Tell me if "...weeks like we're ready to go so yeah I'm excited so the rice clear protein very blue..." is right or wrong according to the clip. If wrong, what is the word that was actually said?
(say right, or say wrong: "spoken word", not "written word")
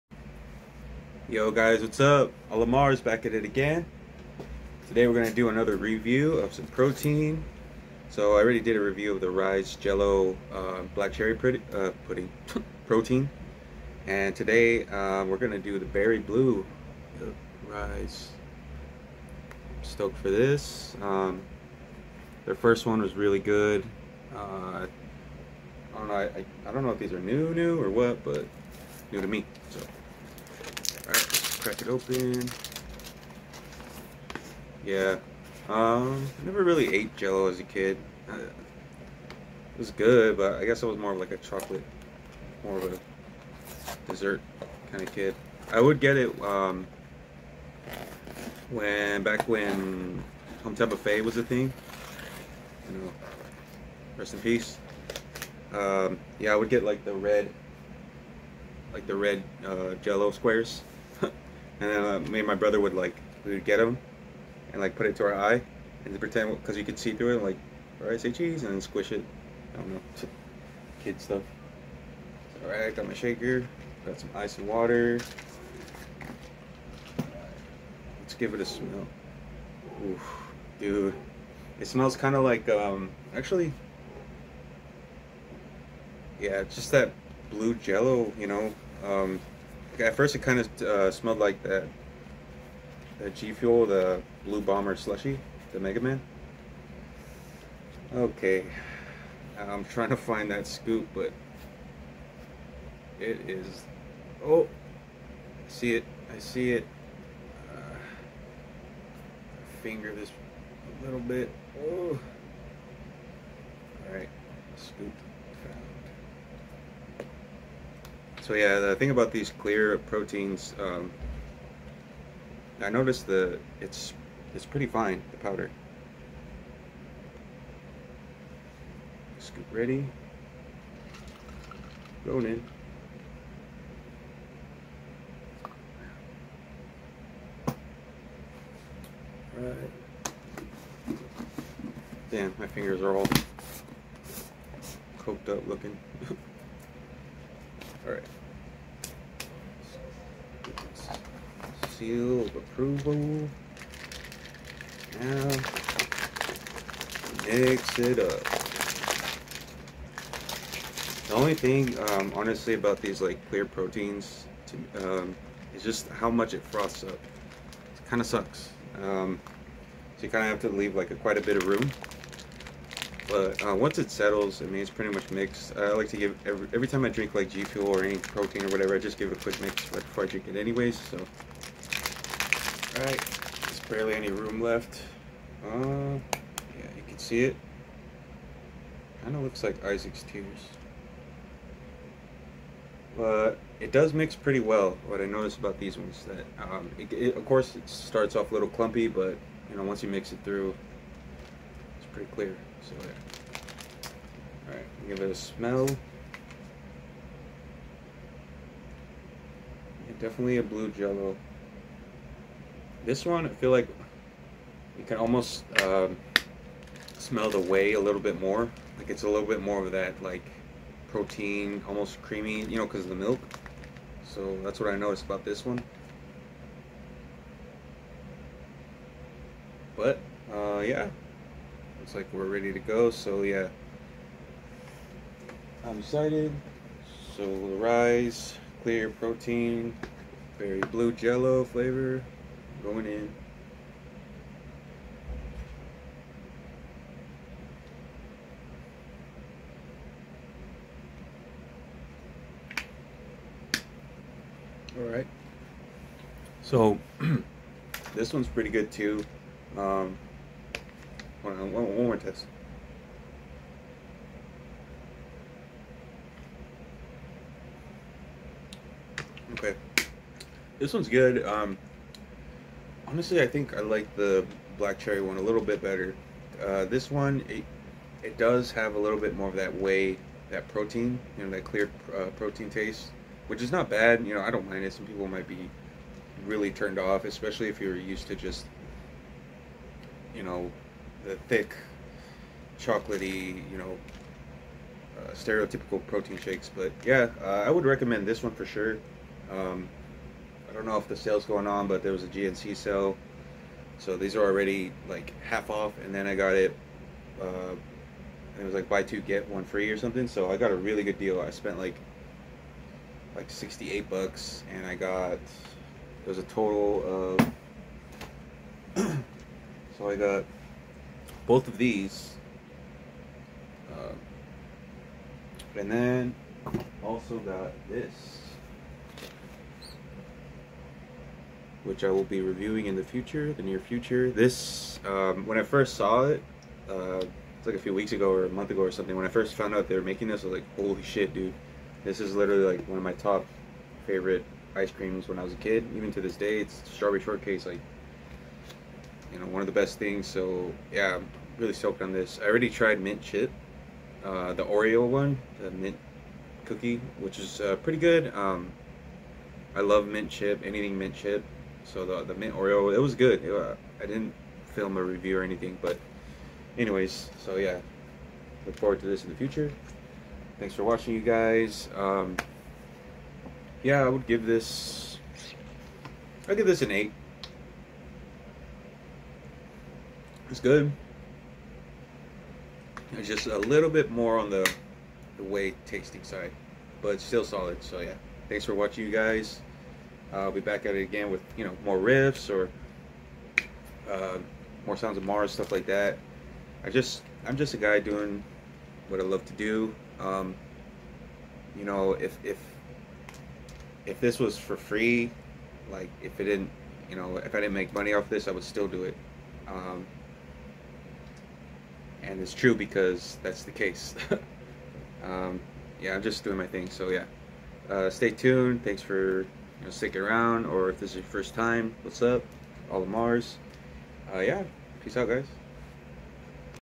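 wrong: "looks", not "weeks".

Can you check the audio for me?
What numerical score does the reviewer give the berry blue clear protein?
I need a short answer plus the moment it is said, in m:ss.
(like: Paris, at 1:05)
8, at 6:16.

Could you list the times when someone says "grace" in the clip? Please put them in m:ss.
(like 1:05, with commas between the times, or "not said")
not said.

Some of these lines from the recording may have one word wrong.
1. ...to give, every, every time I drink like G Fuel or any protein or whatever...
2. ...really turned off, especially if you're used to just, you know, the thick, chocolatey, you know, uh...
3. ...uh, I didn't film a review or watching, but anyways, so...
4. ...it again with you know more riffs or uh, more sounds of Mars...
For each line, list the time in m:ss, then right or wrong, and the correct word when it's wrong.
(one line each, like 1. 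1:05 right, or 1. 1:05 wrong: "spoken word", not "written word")
1. 2:56 right
2. 4:46 right
3. 6:03 wrong: "anything", not "watching"
4. 6:30 right.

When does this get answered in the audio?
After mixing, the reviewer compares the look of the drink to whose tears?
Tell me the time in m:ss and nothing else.
3:09.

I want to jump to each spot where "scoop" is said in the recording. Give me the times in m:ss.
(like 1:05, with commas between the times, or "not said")
1:40, 1:54, 2:09.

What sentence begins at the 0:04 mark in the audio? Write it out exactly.
Today we're gonna do another review of some protein.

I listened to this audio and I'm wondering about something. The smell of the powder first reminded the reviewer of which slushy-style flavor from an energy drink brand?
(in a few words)
Blue Bomber.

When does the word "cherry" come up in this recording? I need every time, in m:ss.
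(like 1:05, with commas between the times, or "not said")
0:11, 4:34.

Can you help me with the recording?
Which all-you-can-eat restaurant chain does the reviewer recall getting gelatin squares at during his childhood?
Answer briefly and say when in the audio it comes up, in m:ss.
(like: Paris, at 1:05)
Hometown Buffet, at 0:50.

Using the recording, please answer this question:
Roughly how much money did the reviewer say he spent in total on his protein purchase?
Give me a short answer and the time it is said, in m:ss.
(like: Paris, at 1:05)
$68, at 5:13.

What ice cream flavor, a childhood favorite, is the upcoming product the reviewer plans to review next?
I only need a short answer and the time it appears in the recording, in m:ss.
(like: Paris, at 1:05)
Strawberry shortcake, at 5:46.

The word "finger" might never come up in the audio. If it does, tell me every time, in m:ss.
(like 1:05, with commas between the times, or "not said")
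1:49, 2:22.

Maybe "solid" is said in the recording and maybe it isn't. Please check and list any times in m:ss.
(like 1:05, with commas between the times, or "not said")
6:27.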